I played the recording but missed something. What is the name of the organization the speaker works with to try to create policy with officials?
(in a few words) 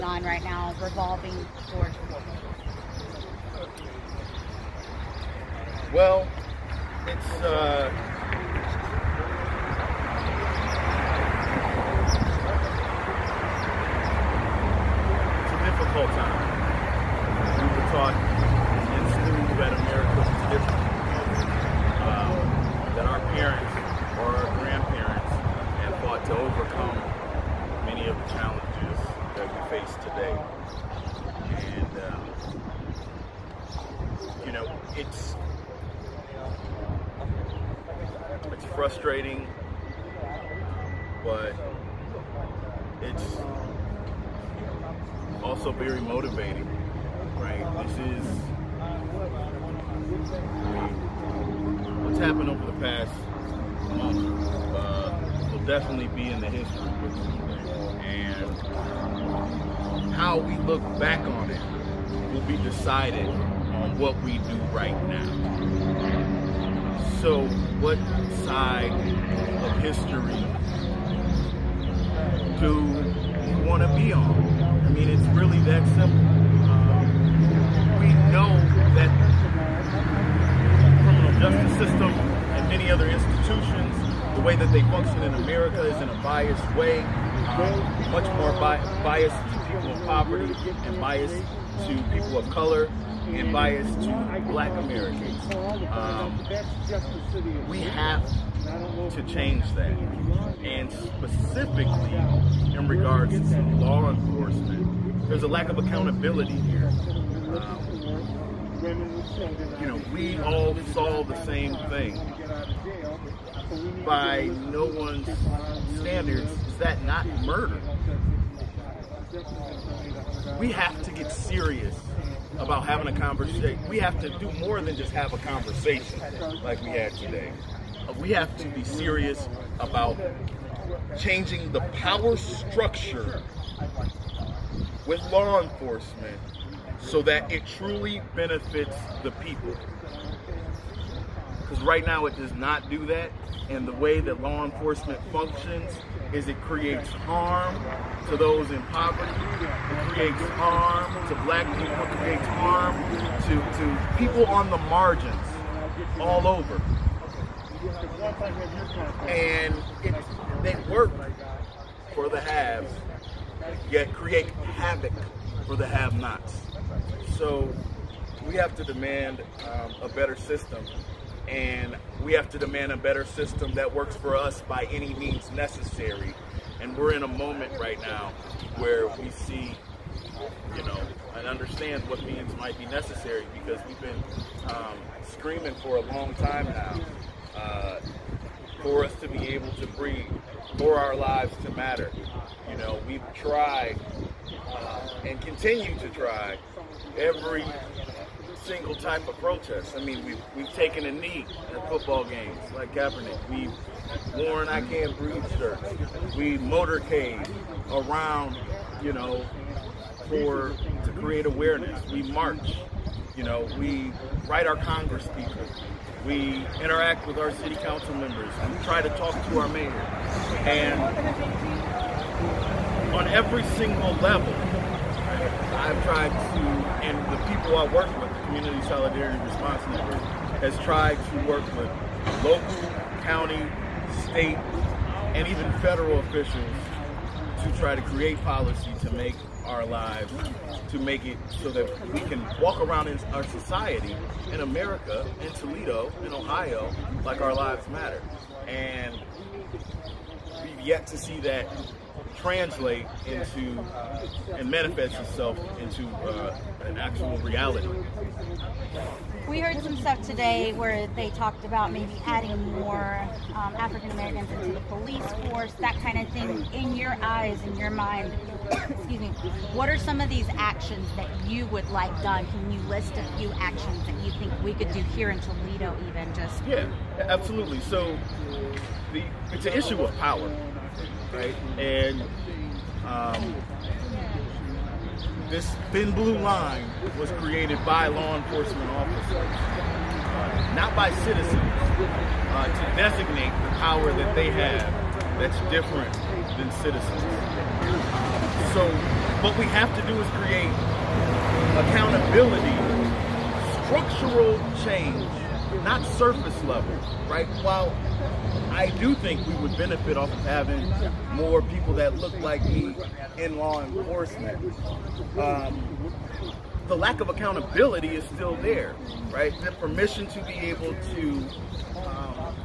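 Community Solidarity Response Network.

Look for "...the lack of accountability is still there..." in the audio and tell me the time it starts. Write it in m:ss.
5:16.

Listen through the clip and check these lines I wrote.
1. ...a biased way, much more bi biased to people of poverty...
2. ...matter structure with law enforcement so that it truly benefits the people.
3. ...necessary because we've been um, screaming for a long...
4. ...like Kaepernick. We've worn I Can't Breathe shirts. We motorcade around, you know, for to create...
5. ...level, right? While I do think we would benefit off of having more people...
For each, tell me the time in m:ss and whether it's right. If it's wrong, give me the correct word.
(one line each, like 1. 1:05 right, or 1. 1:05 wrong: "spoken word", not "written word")
1. 1:26 right
2. 2:11 wrong: "power", not "matter"
3. 3:02 right
4. 3:22 right
5. 5:06 right.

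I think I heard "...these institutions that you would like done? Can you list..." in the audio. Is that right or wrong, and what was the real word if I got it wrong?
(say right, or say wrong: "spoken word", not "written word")
wrong: "actions", not "institutions".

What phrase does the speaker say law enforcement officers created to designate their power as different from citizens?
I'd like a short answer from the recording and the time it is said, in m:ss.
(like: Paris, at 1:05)
thin blue line, at 4:45.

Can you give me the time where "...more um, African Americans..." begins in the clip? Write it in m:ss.
4:22.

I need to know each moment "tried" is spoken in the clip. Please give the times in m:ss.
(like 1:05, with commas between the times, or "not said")
3:13, 3:46, 3:50.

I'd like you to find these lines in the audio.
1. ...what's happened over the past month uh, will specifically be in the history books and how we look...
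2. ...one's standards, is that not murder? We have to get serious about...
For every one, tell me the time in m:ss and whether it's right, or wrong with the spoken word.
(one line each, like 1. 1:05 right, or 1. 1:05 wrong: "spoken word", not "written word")
1. 0:51 wrong: "definitely", not "specifically"
2. 1:54 right.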